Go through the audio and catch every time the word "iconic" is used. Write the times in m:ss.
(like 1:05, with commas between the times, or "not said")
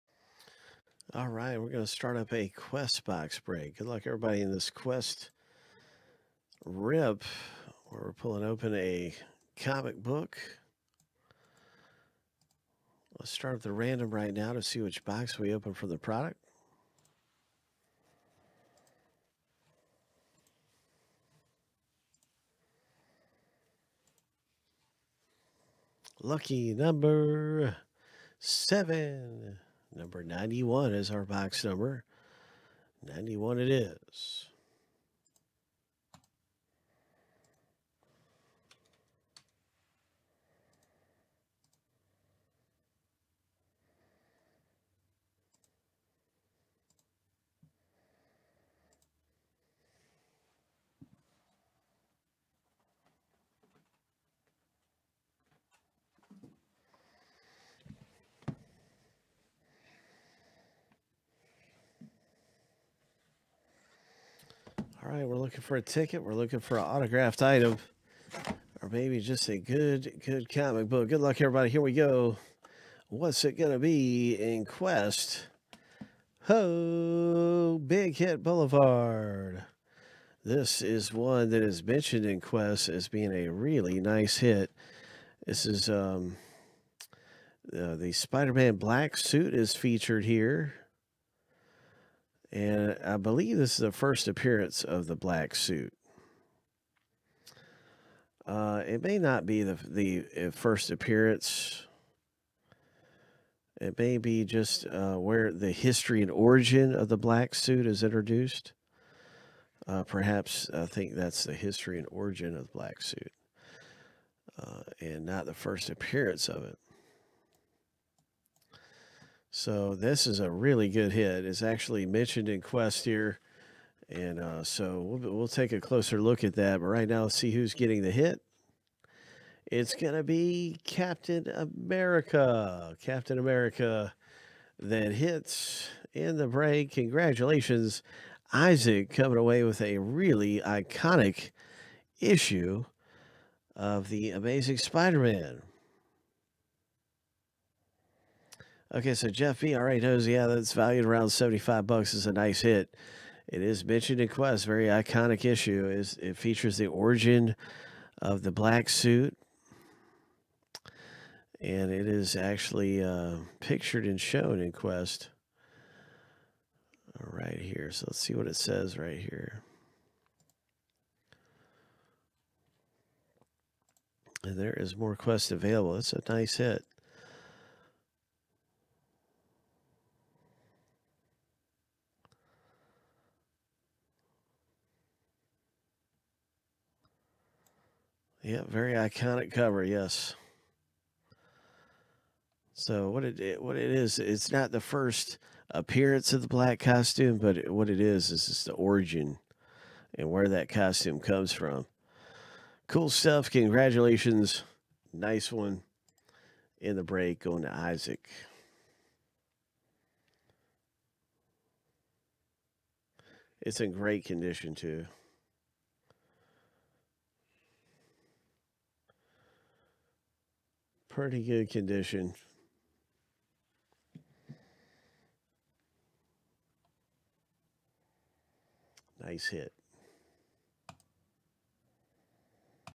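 2:20, 2:34, 3:08.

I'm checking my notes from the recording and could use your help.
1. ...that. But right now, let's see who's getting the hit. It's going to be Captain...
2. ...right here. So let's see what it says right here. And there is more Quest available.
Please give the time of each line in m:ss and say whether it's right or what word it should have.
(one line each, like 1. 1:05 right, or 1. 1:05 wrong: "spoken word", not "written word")
1. 2:06 right
2. 2:47 right.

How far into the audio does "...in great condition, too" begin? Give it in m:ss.
3:33.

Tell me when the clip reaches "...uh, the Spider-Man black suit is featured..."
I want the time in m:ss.
1:27.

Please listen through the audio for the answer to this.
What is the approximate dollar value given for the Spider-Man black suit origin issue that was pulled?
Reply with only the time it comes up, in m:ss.
2:31.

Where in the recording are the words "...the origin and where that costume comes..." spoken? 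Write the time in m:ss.
3:18.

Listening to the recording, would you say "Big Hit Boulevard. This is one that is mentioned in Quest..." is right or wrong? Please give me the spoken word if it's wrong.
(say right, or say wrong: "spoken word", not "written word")
right.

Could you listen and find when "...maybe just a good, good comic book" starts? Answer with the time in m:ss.
1:08.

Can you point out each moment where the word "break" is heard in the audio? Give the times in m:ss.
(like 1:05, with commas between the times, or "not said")
0:03, 2:16, 3:27.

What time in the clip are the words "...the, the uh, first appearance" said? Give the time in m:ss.
1:39.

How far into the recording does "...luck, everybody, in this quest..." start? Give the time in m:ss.
0:03.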